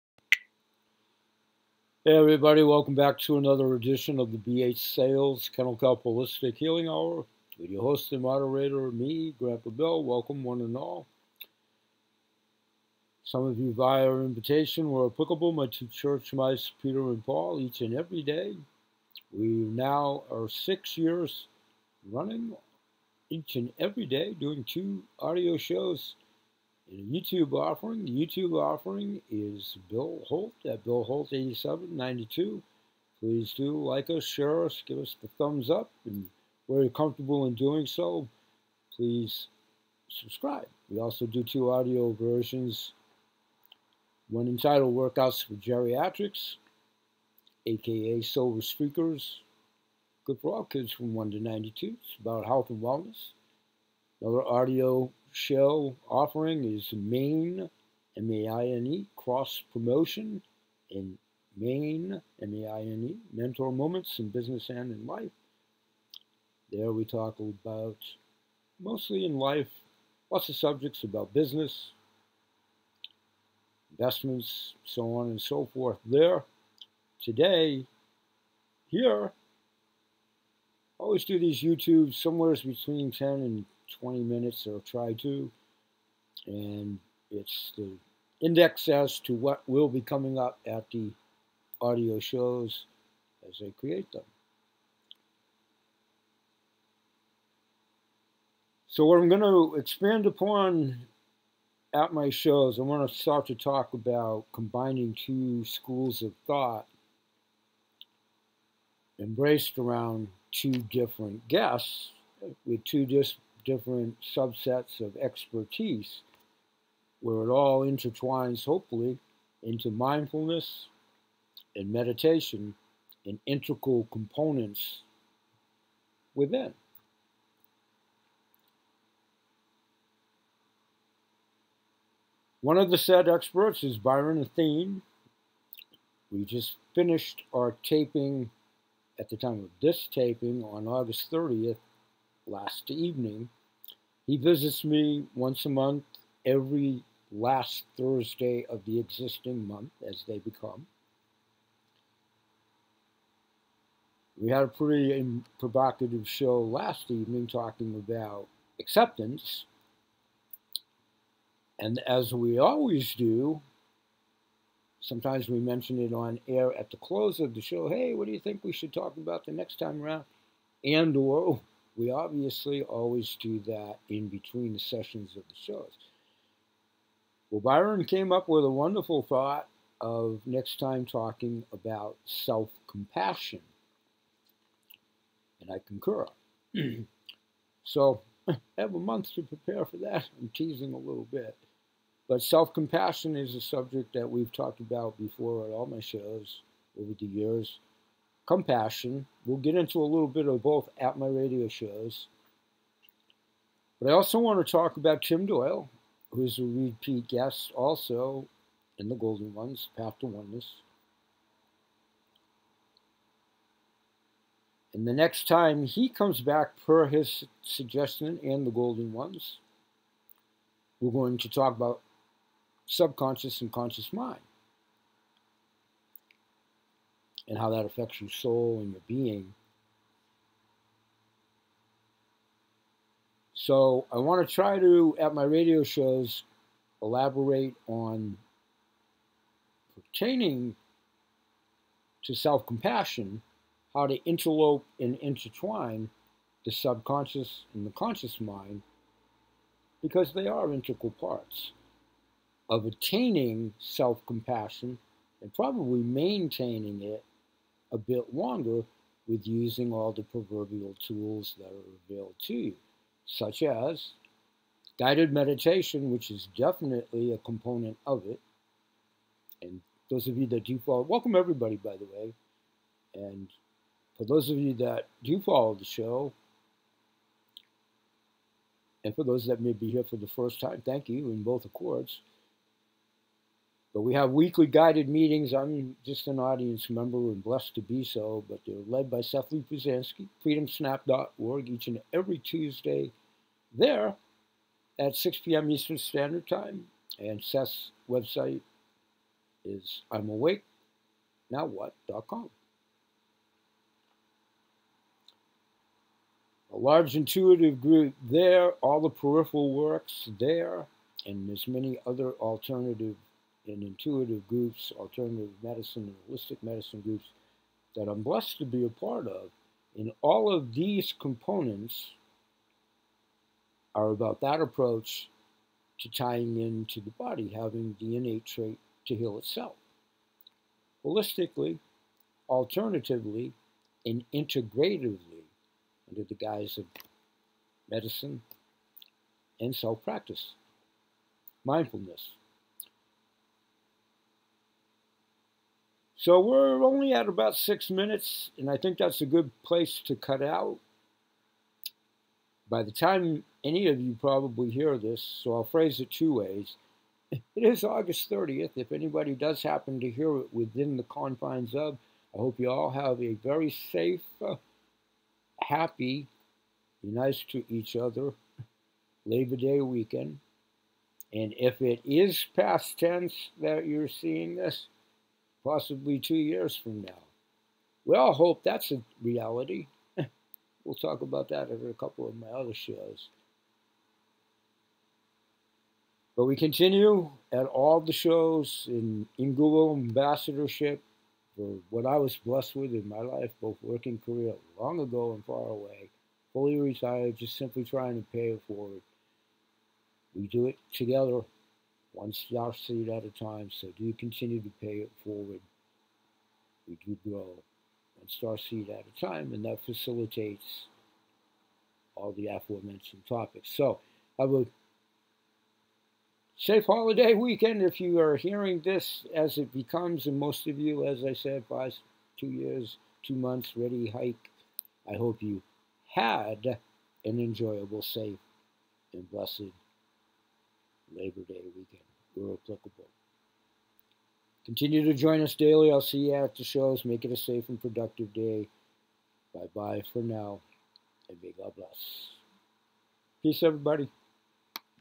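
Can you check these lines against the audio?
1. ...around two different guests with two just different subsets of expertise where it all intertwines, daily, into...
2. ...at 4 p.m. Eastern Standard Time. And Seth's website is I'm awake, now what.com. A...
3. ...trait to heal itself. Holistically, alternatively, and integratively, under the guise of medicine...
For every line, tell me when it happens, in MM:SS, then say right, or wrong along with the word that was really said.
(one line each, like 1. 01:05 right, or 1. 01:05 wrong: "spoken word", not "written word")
1. 01:49 wrong: "hopefully", not "daily"
2. 04:54 wrong: "6", not "4"
3. 05:28 right.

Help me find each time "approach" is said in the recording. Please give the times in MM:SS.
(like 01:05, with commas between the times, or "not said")
05:24.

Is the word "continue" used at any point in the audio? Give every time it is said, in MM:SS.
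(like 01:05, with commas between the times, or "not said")
06:26, 06:44, 07:14.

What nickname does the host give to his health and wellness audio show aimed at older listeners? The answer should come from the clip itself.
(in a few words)
Silver Streakers.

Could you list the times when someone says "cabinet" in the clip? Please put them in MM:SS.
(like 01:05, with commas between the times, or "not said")
not said.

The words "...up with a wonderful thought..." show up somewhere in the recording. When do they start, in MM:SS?
02:58.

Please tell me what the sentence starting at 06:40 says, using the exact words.
We do it together one star seed at a time.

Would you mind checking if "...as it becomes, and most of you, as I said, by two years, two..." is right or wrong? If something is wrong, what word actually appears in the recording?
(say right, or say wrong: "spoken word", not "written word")
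right.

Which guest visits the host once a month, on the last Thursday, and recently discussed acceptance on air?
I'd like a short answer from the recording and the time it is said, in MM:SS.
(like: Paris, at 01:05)
Byron Athene, at 02:13.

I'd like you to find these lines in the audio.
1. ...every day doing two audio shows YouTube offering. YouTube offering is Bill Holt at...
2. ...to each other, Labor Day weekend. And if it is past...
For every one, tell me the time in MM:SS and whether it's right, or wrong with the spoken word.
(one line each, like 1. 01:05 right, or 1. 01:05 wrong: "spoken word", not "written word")
1. 00:23 right
2. 06:07 right.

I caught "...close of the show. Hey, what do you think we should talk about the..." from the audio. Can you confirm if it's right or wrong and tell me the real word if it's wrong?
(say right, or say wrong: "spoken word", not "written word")
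right.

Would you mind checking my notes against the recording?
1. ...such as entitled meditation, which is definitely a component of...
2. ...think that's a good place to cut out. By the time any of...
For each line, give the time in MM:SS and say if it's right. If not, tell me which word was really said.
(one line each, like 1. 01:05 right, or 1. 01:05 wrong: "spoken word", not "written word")
1. 04:23 wrong: "guided", not "entitled"
2. 05:48 right.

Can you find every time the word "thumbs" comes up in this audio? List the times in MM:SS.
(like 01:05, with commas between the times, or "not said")
00:35.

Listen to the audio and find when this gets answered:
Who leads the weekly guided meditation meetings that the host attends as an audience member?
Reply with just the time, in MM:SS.
04:49.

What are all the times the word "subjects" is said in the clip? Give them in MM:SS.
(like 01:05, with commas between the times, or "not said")
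01:10, 03:13.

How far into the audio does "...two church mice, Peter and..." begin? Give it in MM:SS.
00:15.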